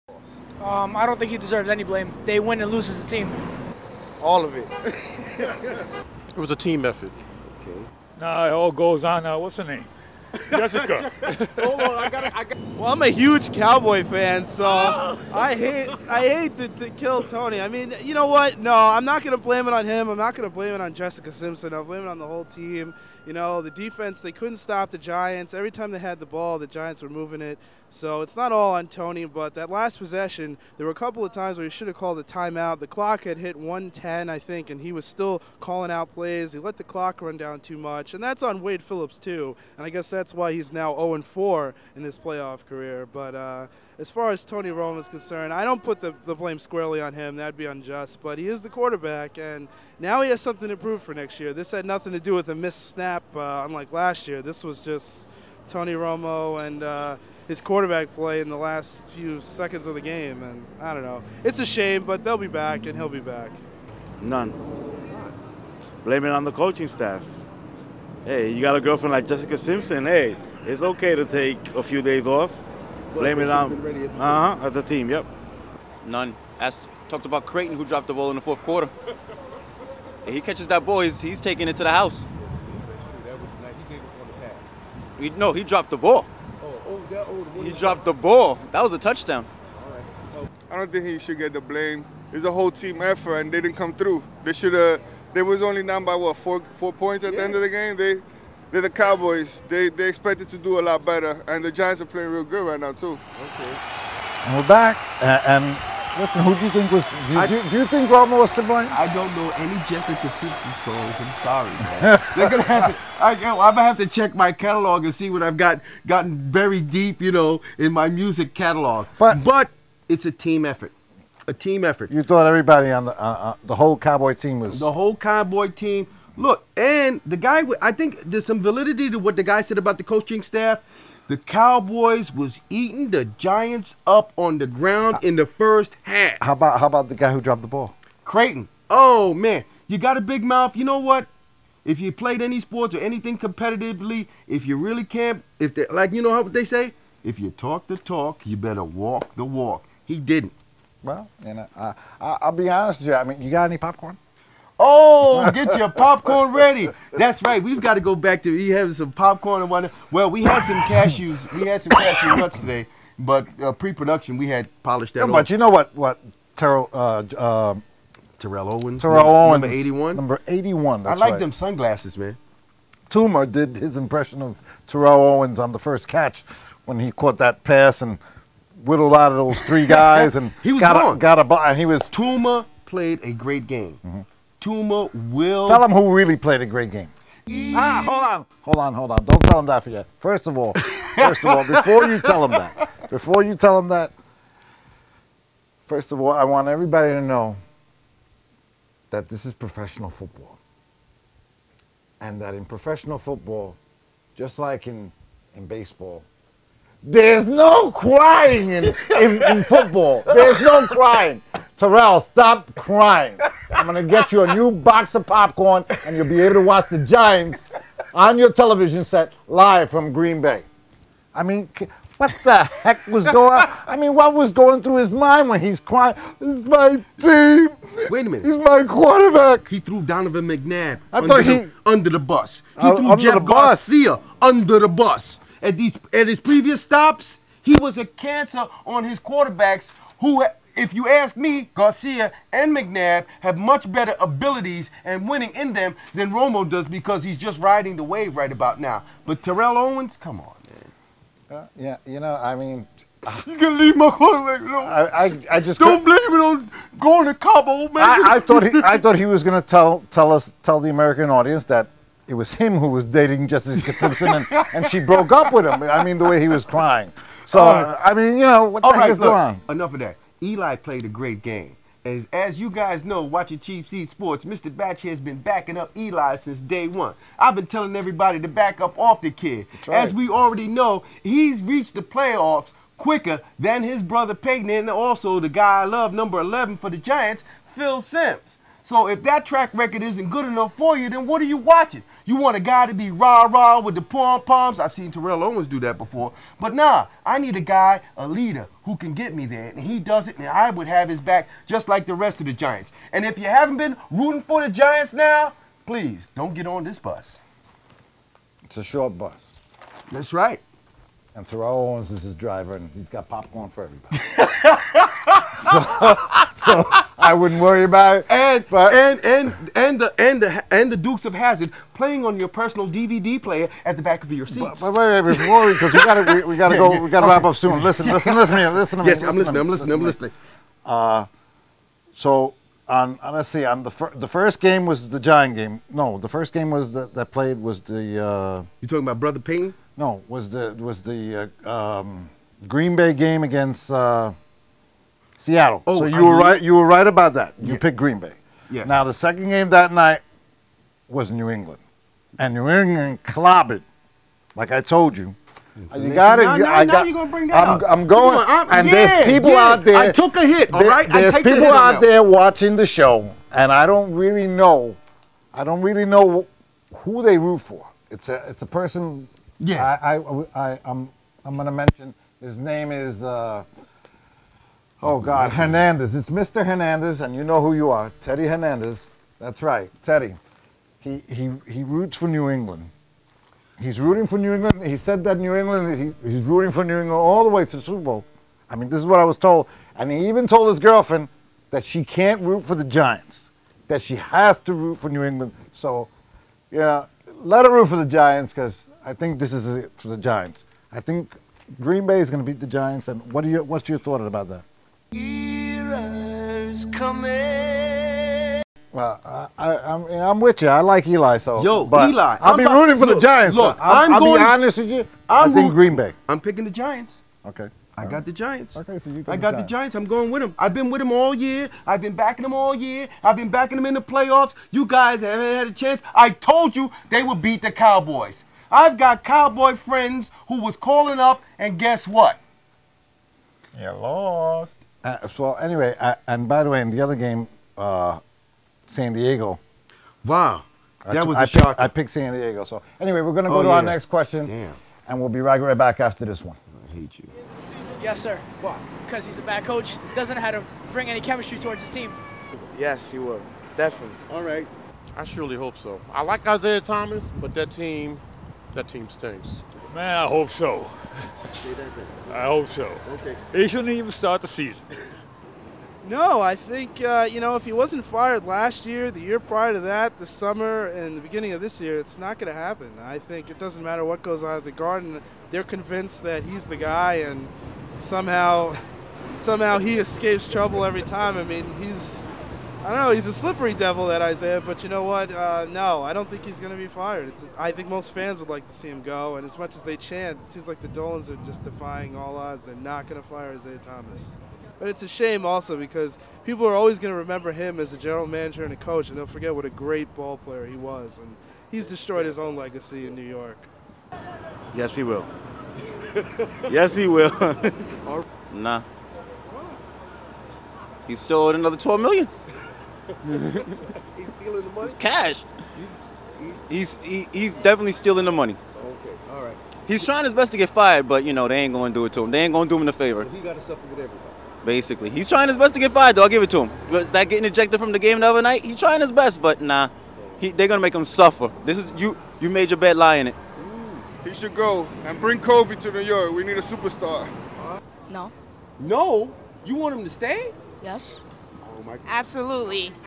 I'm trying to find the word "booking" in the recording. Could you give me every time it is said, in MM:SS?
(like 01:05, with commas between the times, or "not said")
not said.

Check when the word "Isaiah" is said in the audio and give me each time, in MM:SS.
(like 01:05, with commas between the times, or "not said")
07:36, 08:04, 08:13.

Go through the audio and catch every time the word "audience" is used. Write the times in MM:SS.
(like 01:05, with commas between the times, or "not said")
04:21.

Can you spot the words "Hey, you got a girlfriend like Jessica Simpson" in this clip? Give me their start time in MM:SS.
01:08.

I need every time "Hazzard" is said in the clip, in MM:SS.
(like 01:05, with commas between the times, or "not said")
05:21.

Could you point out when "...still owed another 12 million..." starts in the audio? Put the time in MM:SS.
08:31.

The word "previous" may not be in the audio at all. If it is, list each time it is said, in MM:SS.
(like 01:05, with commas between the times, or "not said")
03:56.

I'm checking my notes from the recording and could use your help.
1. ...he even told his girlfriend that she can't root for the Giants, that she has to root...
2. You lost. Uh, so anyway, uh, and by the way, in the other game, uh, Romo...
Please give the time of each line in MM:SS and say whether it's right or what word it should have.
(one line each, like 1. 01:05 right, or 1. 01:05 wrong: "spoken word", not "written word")
1. 06:30 right
2. 07:13 wrong: "San", not "Romo".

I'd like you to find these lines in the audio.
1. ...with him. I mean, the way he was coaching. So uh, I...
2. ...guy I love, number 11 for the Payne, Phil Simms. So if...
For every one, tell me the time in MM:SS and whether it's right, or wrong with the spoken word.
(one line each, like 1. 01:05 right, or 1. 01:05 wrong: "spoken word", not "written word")
1. 04:25 wrong: "crying", not "coaching"
2. 04:45 wrong: "Giants", not "Payne".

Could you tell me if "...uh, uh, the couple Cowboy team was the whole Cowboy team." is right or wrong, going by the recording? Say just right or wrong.
wrong.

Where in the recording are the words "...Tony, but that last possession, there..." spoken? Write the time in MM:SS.
00:28.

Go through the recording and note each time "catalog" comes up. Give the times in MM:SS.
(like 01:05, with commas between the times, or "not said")
01:54, 01:58.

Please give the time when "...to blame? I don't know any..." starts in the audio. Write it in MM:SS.
01:48.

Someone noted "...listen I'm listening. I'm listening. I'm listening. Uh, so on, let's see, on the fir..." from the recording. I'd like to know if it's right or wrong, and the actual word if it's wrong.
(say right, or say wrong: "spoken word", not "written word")
right.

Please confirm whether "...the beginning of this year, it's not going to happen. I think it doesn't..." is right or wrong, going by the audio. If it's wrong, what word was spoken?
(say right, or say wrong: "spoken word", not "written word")
right.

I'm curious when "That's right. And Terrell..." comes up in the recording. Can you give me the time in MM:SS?
05:10.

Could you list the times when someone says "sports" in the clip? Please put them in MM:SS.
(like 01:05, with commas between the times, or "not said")
02:22, 04:34.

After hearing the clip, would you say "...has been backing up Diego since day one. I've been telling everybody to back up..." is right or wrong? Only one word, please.
wrong.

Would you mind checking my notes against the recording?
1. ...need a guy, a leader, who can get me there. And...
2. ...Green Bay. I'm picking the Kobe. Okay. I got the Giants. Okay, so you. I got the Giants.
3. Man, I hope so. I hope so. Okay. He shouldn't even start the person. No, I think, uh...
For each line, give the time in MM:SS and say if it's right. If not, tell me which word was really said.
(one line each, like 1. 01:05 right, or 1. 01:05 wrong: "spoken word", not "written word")
1. 04:57 right
2. 06:55 wrong: "Giants", not "Kobe"
3. 07:39 wrong: "season", not "person".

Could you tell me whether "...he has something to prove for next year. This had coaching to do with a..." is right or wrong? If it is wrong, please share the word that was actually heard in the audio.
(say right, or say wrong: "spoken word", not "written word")
wrong: "nothing", not "coaching".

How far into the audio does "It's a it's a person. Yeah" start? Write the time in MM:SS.
06:08.